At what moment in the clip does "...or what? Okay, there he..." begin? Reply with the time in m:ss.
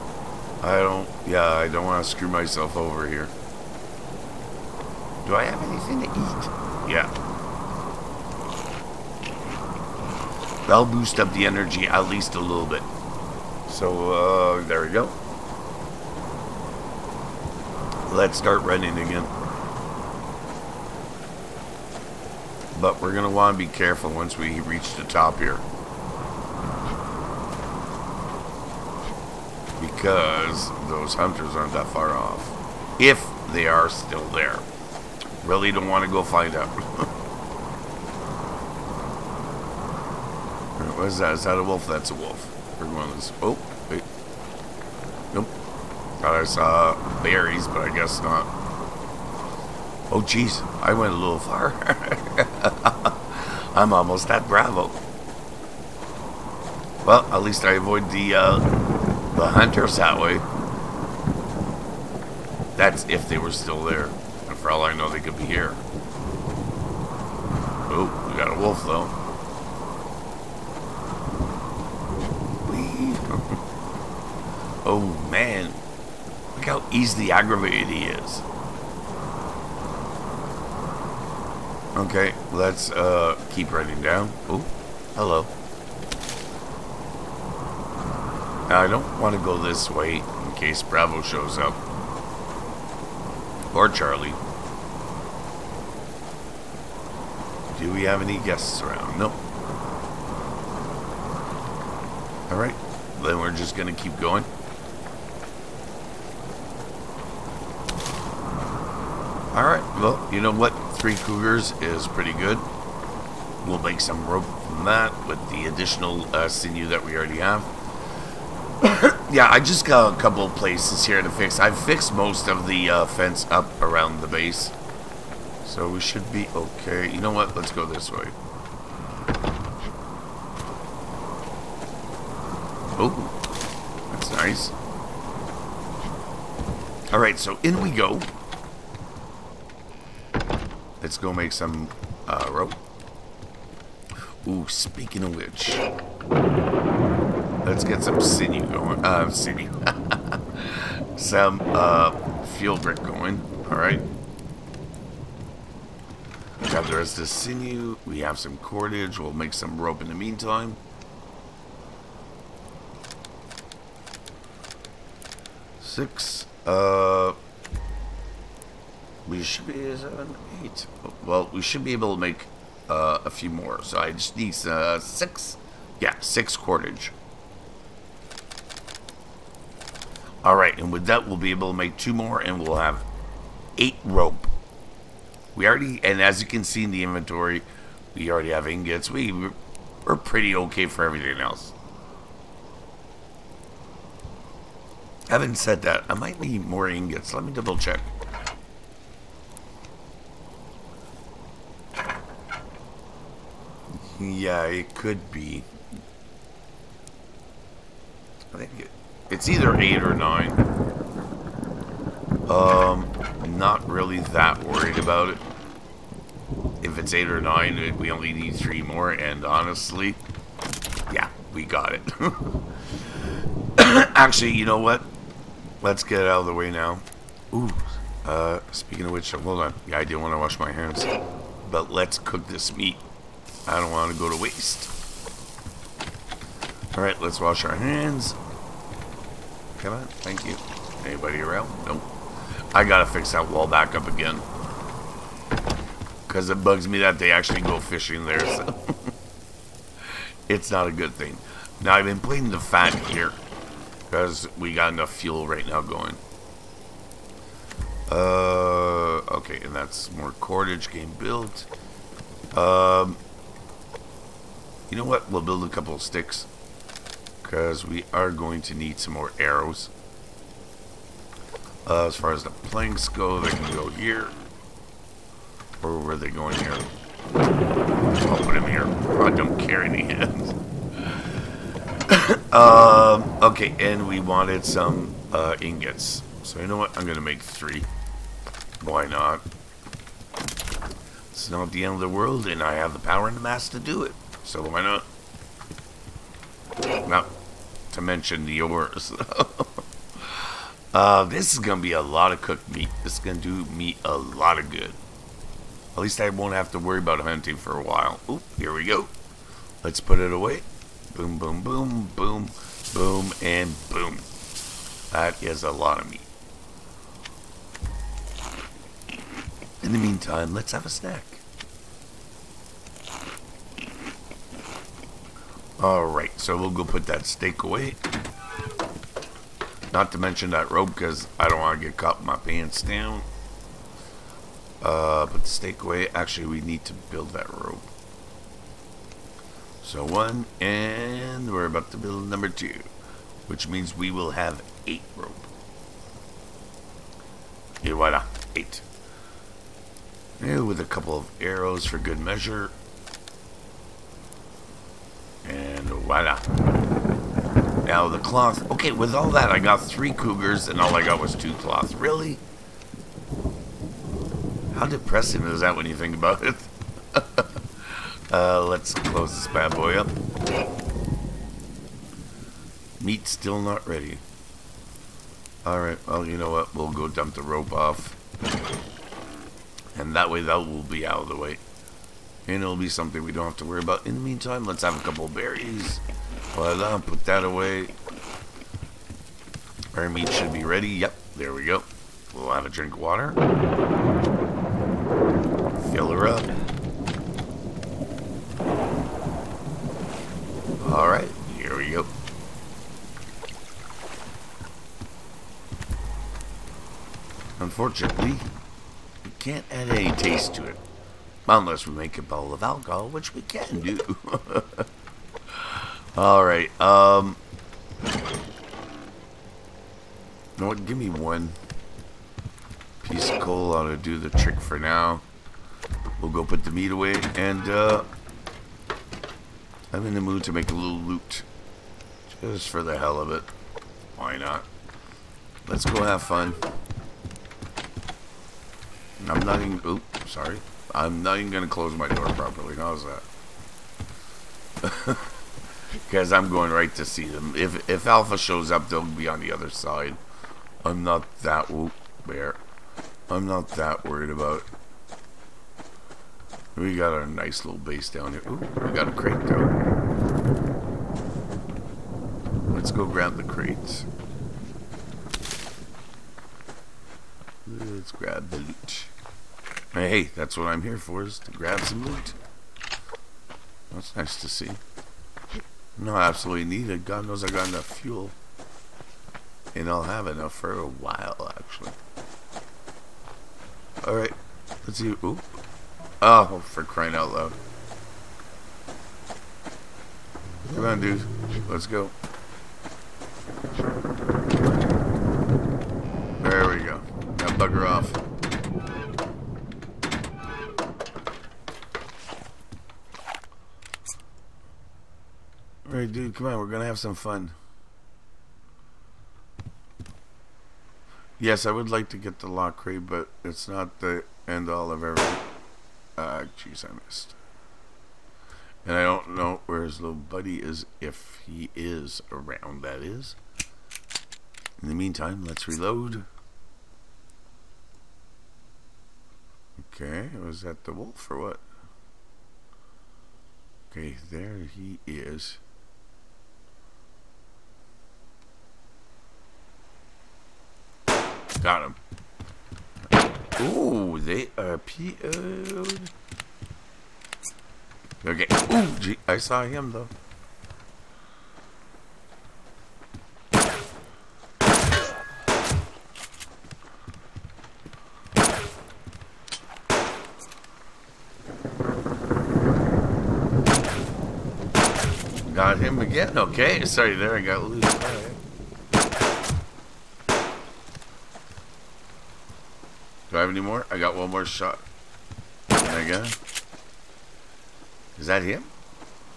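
8:51.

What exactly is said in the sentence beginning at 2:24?
Ooh, speaking of which, let's get some sinew going.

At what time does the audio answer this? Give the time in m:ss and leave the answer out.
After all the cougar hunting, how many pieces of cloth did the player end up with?
6:01.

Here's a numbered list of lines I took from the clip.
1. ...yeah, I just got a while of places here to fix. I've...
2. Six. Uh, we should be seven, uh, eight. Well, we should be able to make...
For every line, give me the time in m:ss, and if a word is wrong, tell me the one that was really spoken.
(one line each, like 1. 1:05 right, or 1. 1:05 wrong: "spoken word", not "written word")
1. 1:59 wrong: "couple", not "while"
2. 2:45 right.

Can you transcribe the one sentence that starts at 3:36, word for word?
If it's 8 or 9, we only need 3 more, and honestly, yeah, we got it.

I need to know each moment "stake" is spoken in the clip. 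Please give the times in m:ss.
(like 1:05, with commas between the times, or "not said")
5:27, 5:35.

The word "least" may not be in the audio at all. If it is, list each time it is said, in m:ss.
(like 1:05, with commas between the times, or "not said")
0:12, 0:57, 5:06.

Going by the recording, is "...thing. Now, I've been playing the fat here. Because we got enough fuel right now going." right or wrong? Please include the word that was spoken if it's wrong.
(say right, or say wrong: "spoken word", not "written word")
right.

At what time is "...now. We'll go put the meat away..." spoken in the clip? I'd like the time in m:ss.
7:04.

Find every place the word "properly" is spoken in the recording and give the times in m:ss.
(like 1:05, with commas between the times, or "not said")
7:22.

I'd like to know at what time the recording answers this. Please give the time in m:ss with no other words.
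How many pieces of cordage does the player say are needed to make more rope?
2:56.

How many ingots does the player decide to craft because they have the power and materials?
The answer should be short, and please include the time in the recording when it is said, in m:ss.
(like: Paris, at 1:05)
3, at 4:46.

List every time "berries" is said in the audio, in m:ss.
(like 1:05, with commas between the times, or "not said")
0:47, 6:25.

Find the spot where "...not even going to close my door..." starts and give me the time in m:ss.
7:21.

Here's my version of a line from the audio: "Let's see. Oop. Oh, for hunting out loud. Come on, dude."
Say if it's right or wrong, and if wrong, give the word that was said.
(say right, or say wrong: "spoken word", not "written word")
wrong: "crying", not "hunting".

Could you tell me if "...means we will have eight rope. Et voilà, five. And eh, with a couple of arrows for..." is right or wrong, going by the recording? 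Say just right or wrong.
wrong.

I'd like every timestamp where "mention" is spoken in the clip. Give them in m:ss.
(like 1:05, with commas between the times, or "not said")
4:58, 5:30.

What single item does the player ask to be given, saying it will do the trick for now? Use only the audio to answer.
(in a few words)
one piece of coal.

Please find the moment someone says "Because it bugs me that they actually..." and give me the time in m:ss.
4:06.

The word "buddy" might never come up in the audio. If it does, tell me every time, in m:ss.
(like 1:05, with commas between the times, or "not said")
8:40.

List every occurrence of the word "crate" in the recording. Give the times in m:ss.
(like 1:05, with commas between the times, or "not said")
7:39, 7:43, 8:32.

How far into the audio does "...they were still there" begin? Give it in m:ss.
1:03.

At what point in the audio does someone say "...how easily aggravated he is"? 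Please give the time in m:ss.
1:16.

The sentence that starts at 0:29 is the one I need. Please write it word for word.
Because those hunters aren't that far off.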